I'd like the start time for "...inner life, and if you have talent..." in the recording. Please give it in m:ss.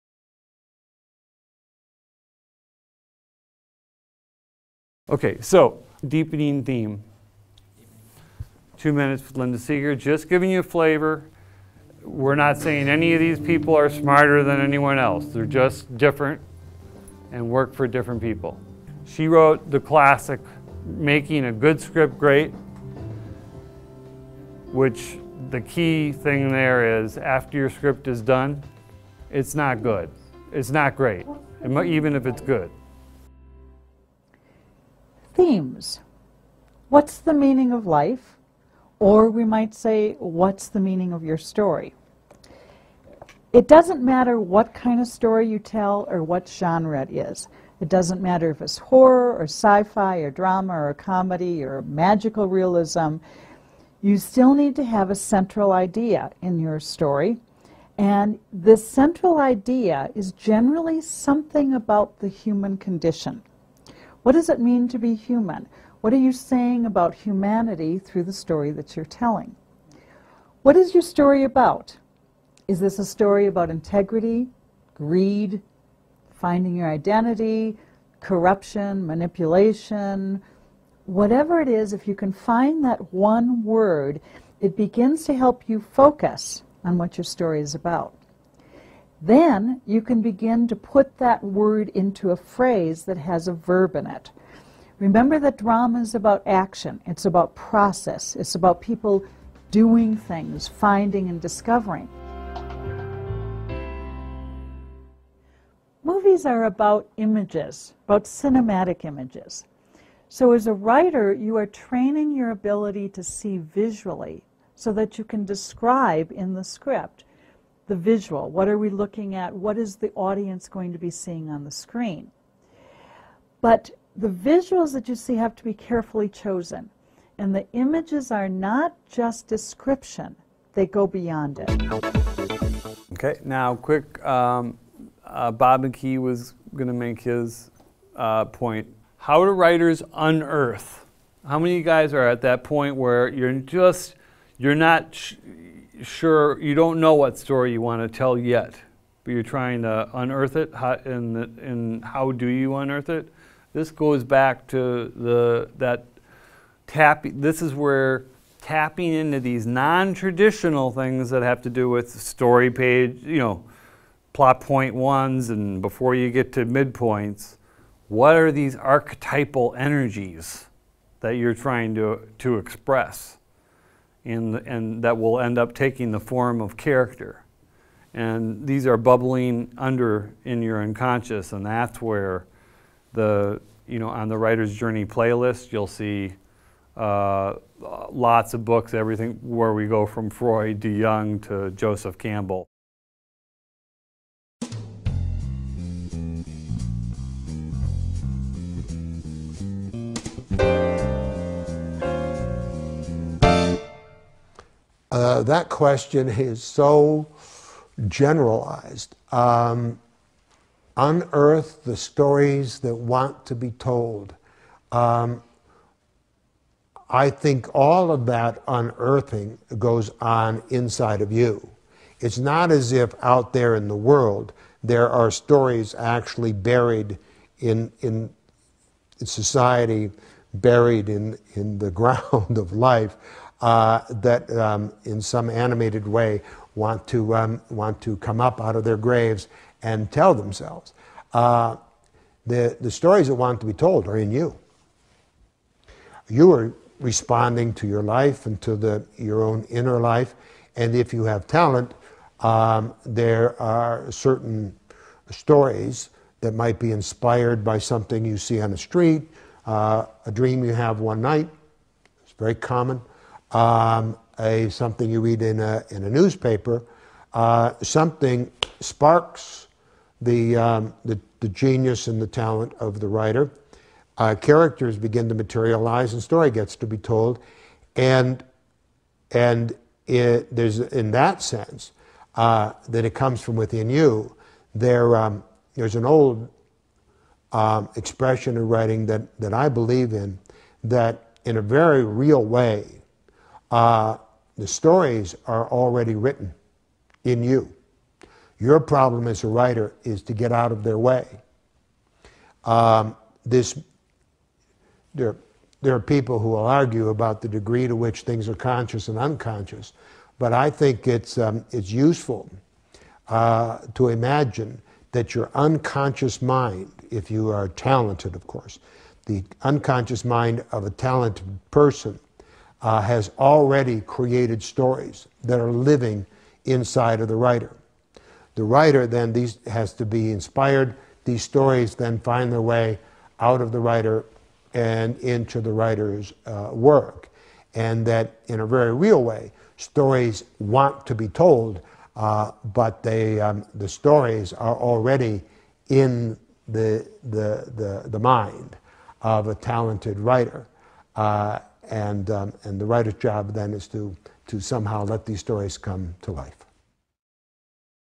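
4:09.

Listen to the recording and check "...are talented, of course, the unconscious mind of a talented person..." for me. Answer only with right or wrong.
right.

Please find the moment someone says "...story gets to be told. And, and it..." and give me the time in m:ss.
4:36.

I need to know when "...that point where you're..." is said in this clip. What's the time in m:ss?
2:22.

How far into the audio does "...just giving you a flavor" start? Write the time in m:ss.
0:09.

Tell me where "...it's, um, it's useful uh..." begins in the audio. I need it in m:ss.
5:11.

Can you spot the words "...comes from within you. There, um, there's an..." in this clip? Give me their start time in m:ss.
4:43.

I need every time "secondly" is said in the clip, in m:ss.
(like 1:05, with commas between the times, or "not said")
not said.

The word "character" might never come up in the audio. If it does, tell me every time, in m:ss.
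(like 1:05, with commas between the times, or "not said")
2:56, 4:34.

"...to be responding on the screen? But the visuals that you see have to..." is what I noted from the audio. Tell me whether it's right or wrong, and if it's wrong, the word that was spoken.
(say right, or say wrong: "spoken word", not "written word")
wrong: "seeing", not "responding".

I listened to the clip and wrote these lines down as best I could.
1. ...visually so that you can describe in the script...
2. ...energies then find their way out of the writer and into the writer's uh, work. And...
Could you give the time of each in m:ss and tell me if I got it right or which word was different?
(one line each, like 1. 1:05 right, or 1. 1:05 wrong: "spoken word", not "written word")
1. 1:53 right
2. 5:31 wrong: "stories", not "energies".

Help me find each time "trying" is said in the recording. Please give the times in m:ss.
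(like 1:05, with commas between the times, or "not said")
2:29, 2:51.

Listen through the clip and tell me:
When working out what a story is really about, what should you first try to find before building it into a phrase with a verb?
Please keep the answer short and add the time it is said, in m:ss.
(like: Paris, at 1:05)
one word, at 1:23.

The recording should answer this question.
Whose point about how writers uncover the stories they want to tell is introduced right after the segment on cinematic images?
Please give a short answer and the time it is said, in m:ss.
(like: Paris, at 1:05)
Bob McKee, at 2:15.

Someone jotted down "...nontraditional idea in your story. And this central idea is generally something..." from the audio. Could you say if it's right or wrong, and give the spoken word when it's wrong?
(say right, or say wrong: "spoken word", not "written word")
wrong: "central", not "nontraditional".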